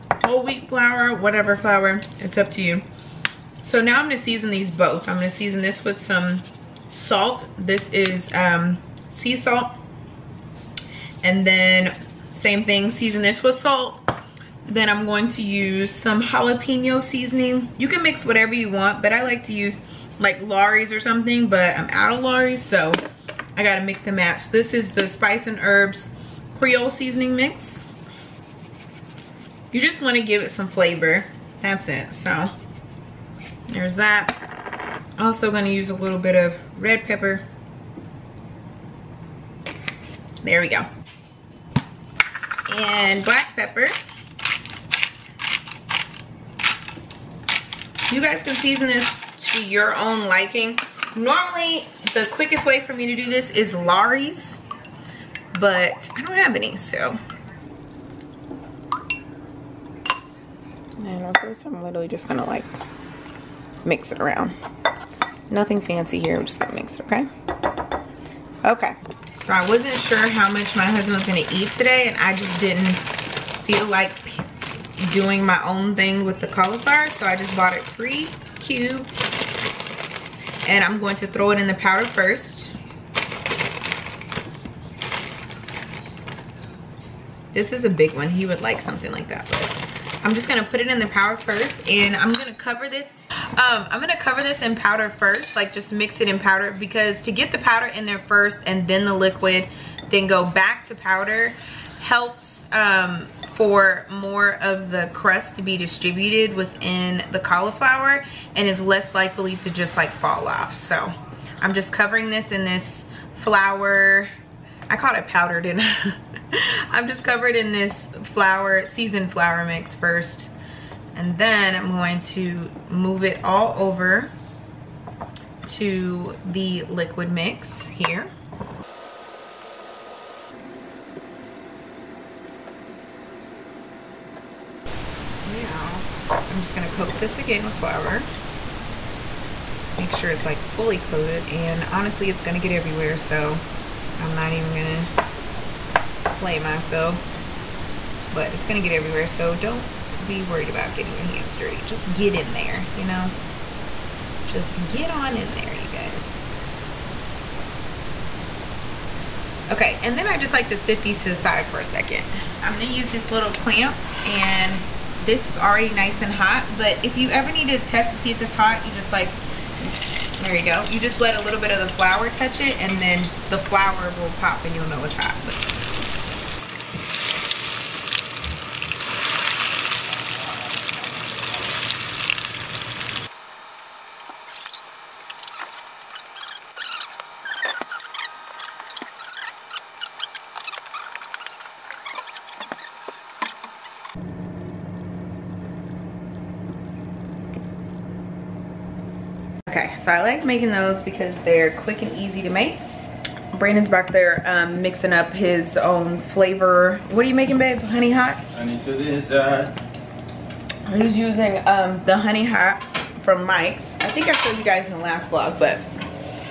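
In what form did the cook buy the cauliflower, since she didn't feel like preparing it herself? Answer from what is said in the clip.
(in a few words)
Pre-cubed.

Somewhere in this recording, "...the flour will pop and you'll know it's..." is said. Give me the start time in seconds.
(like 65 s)
173 s.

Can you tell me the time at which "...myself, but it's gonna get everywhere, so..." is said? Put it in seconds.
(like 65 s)
146 s.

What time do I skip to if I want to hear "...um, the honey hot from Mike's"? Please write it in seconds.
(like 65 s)
211 s.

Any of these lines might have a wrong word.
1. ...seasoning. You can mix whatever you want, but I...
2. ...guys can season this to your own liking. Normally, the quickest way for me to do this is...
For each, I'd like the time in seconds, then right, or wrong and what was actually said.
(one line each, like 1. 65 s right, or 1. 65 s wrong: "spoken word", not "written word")
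1. 17 s right
2. 48 s right.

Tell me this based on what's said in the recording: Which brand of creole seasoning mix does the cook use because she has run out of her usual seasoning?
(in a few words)
Spice and Herbs.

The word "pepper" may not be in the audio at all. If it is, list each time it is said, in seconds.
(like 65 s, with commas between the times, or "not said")
37 s, 43 s.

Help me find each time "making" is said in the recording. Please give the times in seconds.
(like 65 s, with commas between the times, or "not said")
200 s, 207 s.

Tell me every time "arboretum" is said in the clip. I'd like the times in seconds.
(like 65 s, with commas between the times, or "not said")
not said.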